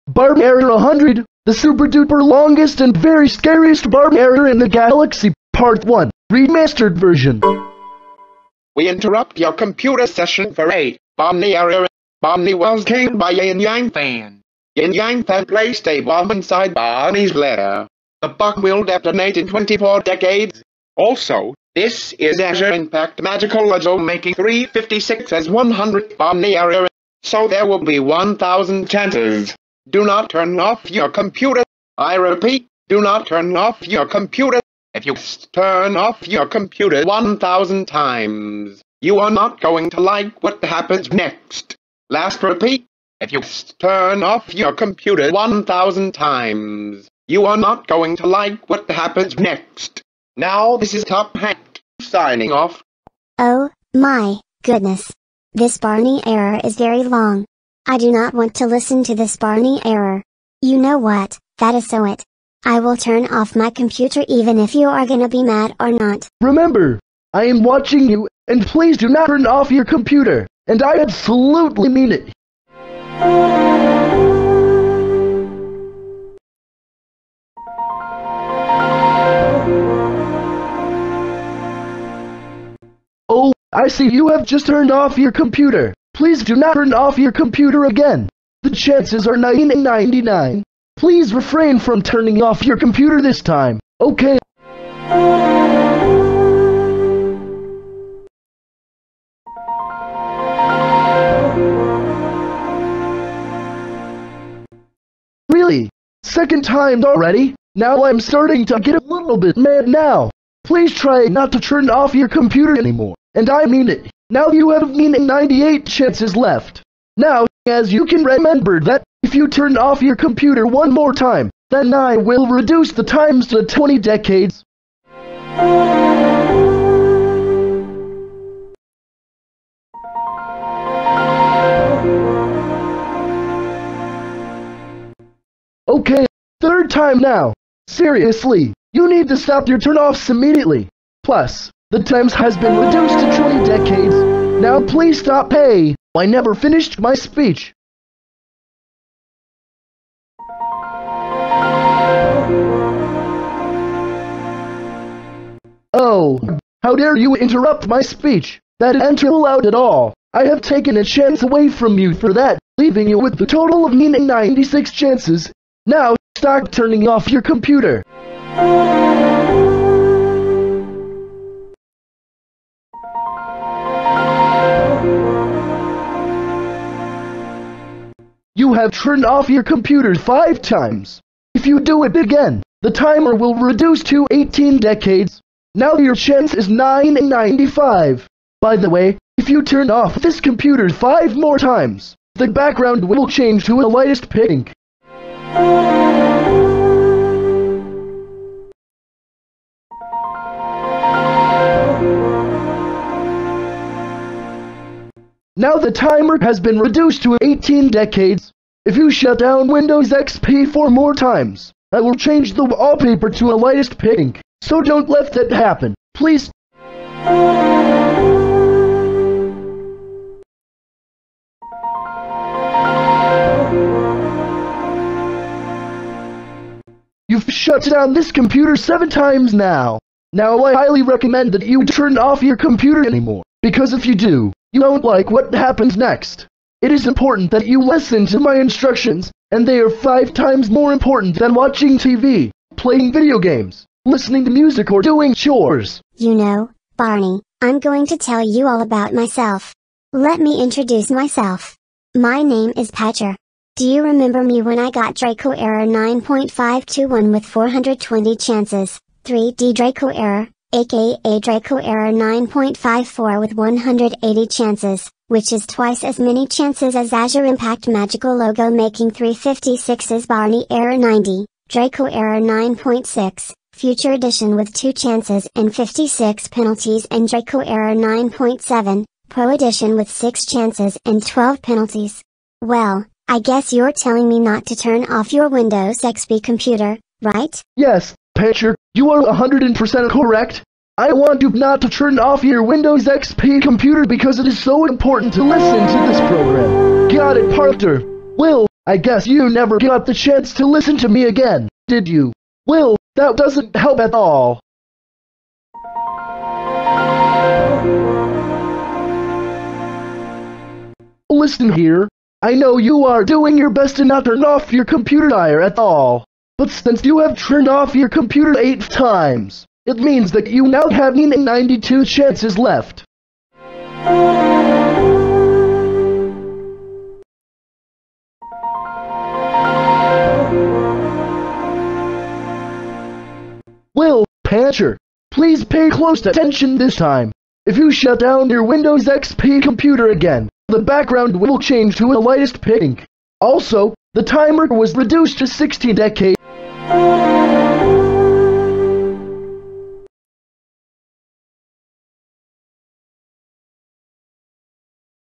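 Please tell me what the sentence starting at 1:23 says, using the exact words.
Oh, I see you have just turned off your computer.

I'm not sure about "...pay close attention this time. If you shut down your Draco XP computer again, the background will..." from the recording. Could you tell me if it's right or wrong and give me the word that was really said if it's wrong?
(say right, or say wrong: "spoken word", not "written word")
wrong: "Windows", not "Draco".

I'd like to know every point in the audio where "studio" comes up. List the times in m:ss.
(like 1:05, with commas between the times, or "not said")
not said.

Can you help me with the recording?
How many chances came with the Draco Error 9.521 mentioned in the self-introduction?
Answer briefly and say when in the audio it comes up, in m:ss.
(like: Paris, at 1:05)
420, at 4:17.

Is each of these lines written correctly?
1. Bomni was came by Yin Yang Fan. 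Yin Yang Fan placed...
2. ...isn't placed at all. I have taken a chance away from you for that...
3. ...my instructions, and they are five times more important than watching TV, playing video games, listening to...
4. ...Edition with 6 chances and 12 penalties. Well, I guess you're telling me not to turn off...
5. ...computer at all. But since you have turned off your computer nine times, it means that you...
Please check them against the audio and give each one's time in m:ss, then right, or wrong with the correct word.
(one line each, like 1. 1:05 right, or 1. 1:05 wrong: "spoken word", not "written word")
1. 0:12 right
2. 2:38 wrong: "allowed", not "placed"
3. 3:58 right
4. 4:39 right
5. 5:14 wrong: "eight", not "nine".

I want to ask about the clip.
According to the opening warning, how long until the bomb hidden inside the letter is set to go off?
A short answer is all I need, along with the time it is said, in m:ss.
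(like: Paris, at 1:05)
24 decades, at 0:19.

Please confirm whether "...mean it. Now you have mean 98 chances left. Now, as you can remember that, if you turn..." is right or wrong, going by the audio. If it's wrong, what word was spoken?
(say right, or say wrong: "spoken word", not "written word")
right.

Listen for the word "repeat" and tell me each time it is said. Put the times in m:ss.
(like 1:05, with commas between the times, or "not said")
0:32, 0:42.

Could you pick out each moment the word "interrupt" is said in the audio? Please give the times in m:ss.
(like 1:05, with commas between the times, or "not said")
0:08, 2:37.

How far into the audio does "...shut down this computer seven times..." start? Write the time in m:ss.
3:47.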